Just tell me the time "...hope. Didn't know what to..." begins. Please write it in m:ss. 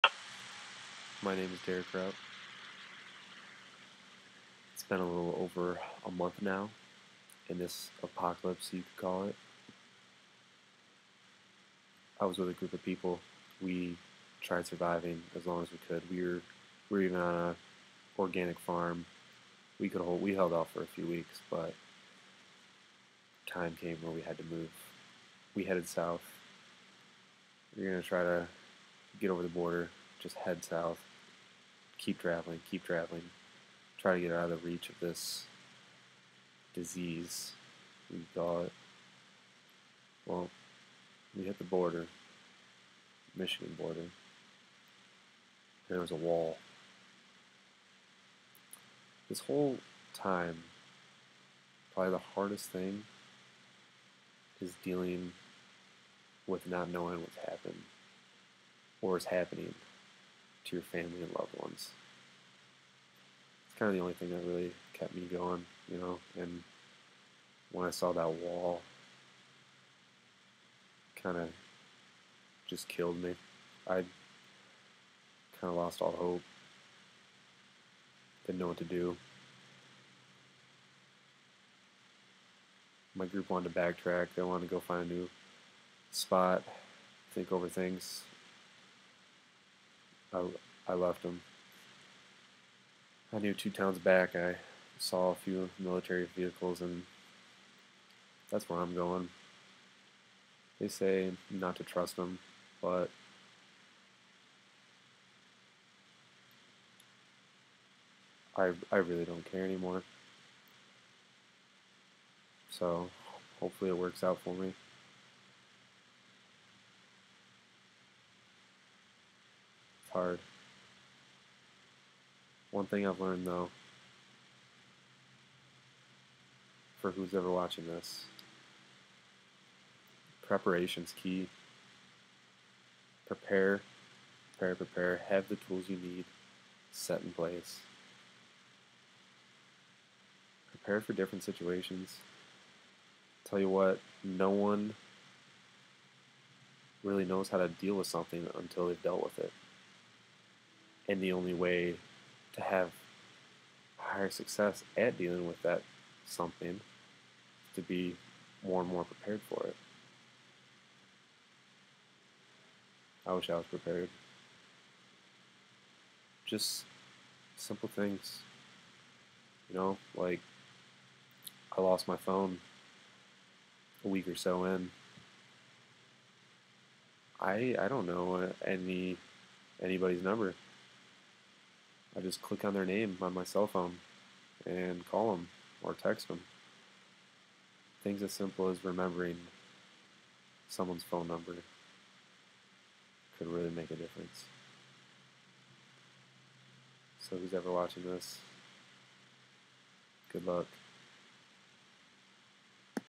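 1:16.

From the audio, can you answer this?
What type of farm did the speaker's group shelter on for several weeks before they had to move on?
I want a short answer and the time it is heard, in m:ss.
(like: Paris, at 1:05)
Organic farm, at 0:18.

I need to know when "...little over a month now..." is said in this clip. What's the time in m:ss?
0:05.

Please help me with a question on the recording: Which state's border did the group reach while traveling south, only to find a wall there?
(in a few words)
Michigan.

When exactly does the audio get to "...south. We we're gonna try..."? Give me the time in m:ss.
0:25.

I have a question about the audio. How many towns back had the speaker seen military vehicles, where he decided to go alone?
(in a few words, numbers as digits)
2.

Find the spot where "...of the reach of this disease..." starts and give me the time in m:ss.
0:34.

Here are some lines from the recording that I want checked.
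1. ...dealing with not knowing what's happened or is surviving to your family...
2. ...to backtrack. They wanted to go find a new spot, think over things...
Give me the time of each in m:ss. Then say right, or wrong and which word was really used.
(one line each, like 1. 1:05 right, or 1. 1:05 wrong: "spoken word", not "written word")
1. 0:54 wrong: "happening", not "surviving"
2. 1:23 right.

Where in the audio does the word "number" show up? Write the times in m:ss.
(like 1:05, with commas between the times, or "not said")
3:00, 3:11.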